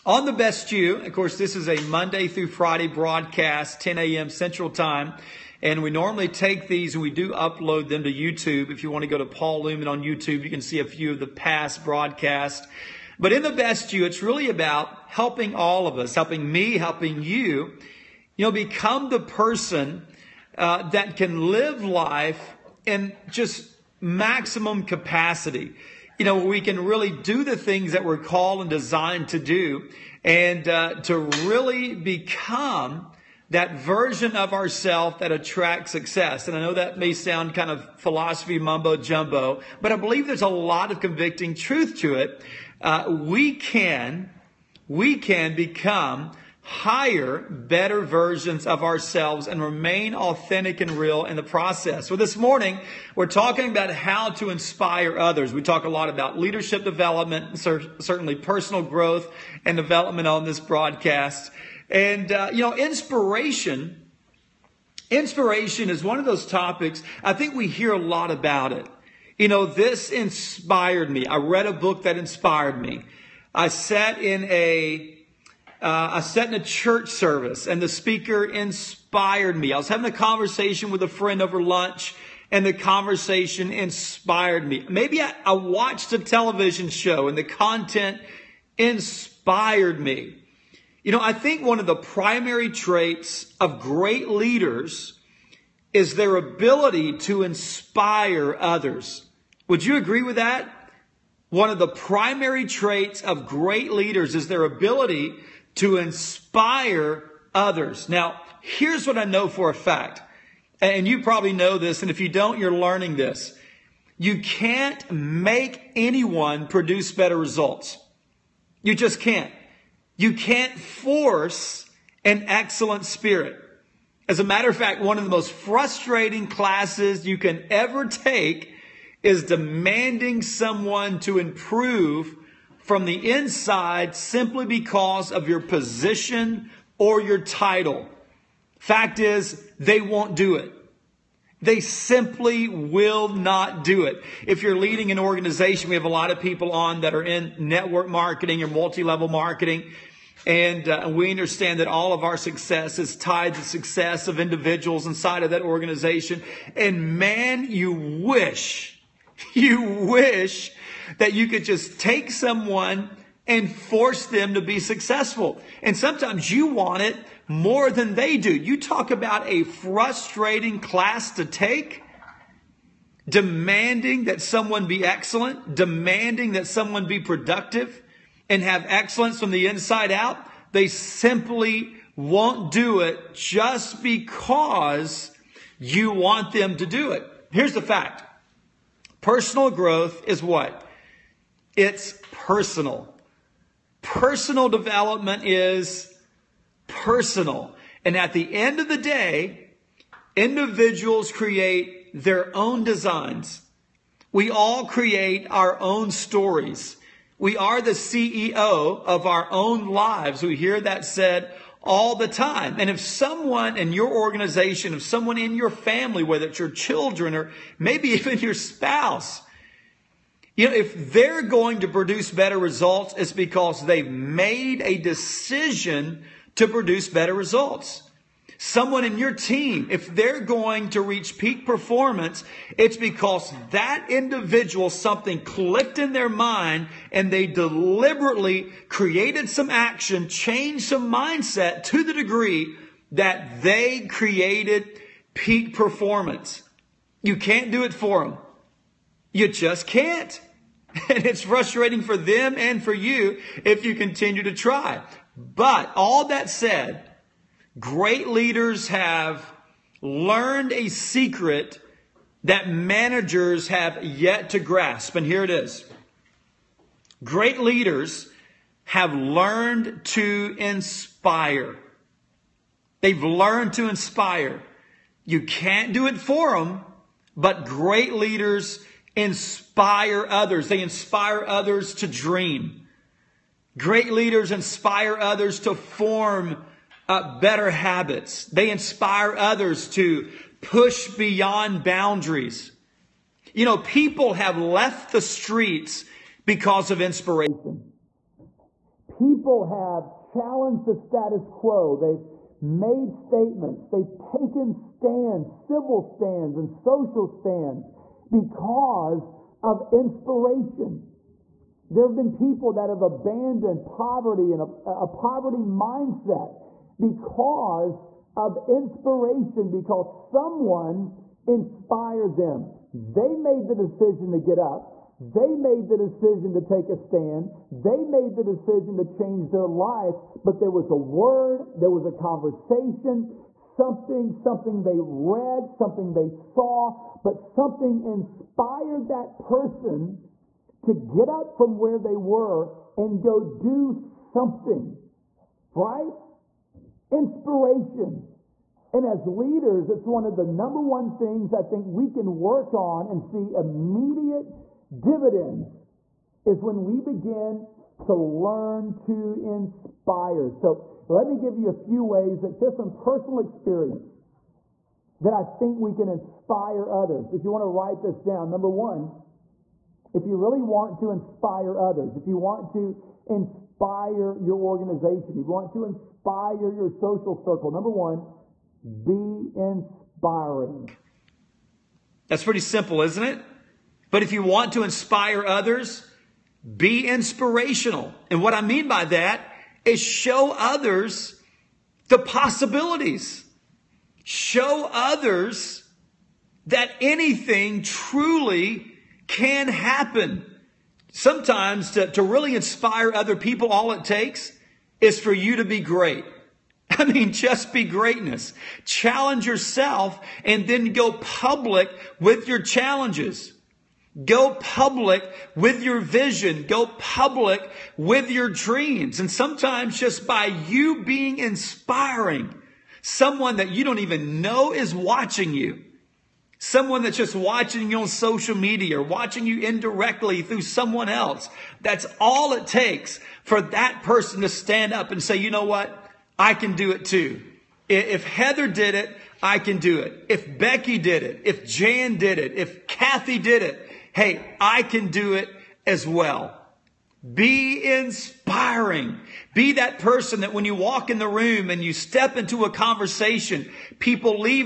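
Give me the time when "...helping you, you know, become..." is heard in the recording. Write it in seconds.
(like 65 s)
16 s.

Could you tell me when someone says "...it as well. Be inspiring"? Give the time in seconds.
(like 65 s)
445 s.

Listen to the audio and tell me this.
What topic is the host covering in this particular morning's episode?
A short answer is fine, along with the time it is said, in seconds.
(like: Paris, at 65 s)
how to inspire others, at 53 s.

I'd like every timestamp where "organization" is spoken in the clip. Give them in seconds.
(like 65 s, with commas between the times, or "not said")
145 s, 155 s, 214 s, 374 s.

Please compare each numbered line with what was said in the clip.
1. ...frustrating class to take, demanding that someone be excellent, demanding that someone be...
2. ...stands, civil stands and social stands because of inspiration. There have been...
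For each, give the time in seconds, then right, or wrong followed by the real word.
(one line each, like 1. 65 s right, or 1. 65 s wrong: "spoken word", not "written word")
1. 169 s right
2. 304 s right.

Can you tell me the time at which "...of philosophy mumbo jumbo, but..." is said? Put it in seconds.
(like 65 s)
37 s.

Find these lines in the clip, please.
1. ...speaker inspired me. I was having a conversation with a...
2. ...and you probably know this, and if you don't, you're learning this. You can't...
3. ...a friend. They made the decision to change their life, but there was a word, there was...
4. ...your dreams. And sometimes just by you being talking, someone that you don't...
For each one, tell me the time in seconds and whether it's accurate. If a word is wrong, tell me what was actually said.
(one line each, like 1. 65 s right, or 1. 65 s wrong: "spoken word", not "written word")
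1. 77 s right
2. 110 s right
3. 326 s wrong: "stand", not "friend"
4. 418 s wrong: "inspiring", not "talking".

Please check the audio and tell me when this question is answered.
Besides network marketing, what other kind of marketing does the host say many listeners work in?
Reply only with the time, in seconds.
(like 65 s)
148 s.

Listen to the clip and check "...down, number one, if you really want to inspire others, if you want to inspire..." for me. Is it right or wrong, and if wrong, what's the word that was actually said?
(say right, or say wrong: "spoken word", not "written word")
right.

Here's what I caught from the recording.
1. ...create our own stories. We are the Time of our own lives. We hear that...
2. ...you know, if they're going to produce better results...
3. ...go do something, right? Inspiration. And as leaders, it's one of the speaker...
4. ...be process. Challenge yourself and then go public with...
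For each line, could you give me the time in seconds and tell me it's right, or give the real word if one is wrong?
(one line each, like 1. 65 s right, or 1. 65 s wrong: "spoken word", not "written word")
1. 204 s wrong: "CEO", not "Time"
2. 220 s right
3. 343 s wrong: "number", not "speaker"
4. 407 s wrong: "greatness", not "process".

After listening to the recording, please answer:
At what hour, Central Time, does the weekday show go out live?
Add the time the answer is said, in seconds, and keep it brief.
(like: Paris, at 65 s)
10 a.m., at 3 s.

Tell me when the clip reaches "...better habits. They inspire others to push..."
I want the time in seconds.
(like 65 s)
287 s.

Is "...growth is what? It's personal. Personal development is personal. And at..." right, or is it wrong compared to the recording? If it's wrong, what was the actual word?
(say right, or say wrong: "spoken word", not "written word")
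right.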